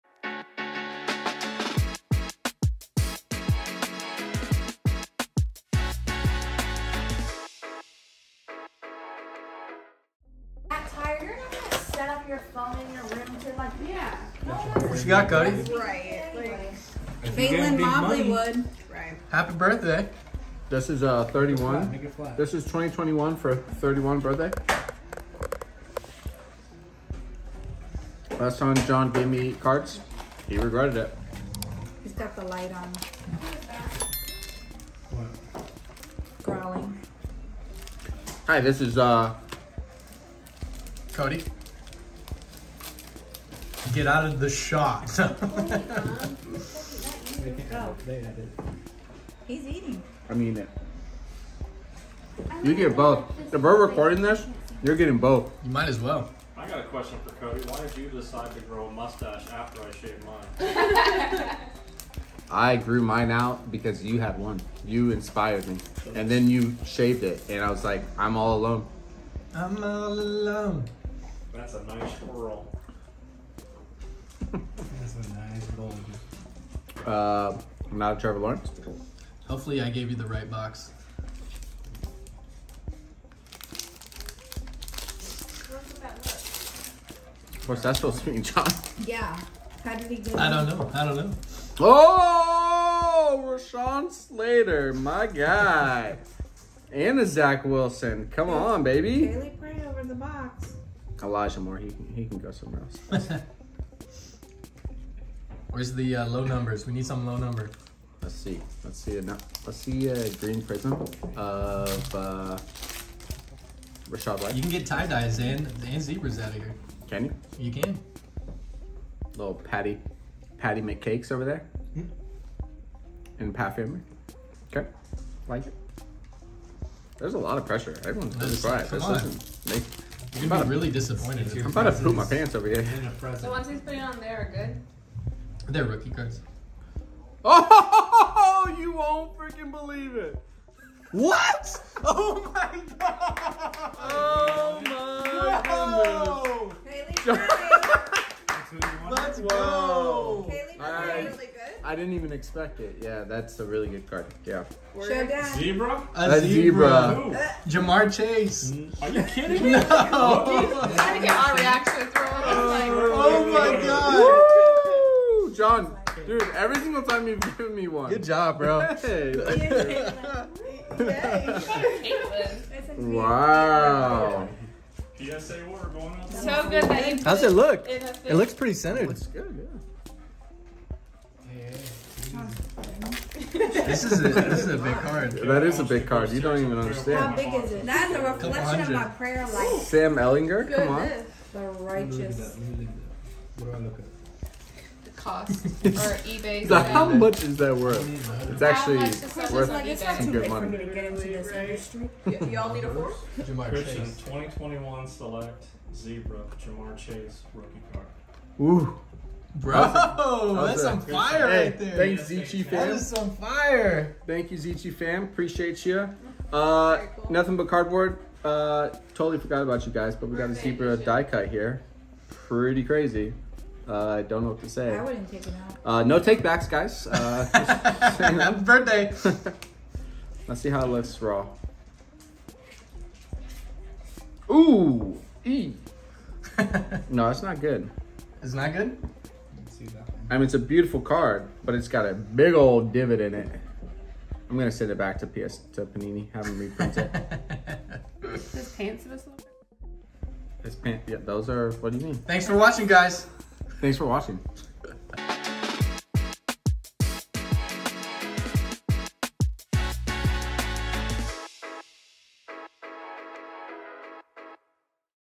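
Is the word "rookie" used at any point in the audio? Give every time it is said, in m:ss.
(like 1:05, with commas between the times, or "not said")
2:15, 3:27.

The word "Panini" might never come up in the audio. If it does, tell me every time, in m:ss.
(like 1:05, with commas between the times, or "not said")
4:05.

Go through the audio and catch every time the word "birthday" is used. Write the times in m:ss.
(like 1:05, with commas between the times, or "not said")
0:19, 0:24, 3:48.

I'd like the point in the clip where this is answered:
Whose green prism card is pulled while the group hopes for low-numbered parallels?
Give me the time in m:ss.
1:54.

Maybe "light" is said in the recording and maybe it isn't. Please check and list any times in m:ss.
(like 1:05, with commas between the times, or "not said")
0:32.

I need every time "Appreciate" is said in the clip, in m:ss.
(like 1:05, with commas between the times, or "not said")
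3:35.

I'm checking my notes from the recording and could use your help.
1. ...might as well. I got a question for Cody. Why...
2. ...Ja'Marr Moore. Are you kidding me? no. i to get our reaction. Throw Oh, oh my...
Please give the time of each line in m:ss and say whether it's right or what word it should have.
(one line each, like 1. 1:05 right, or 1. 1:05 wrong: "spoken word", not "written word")
1. 0:55 right
2. 2:37 wrong: "Chase", not "Moore".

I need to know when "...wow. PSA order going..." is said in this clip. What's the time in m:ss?
2:52.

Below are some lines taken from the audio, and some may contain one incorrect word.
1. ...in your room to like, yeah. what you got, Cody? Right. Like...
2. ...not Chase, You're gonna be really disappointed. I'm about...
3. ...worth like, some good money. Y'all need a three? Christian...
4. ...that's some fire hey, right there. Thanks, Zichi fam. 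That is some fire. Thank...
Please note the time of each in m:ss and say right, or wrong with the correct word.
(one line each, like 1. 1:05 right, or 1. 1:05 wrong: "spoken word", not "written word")
1. 0:12 right
2. 2:08 wrong: "Make", not "Chase"
3. 3:19 wrong: "four", not "three"
4. 3:30 right.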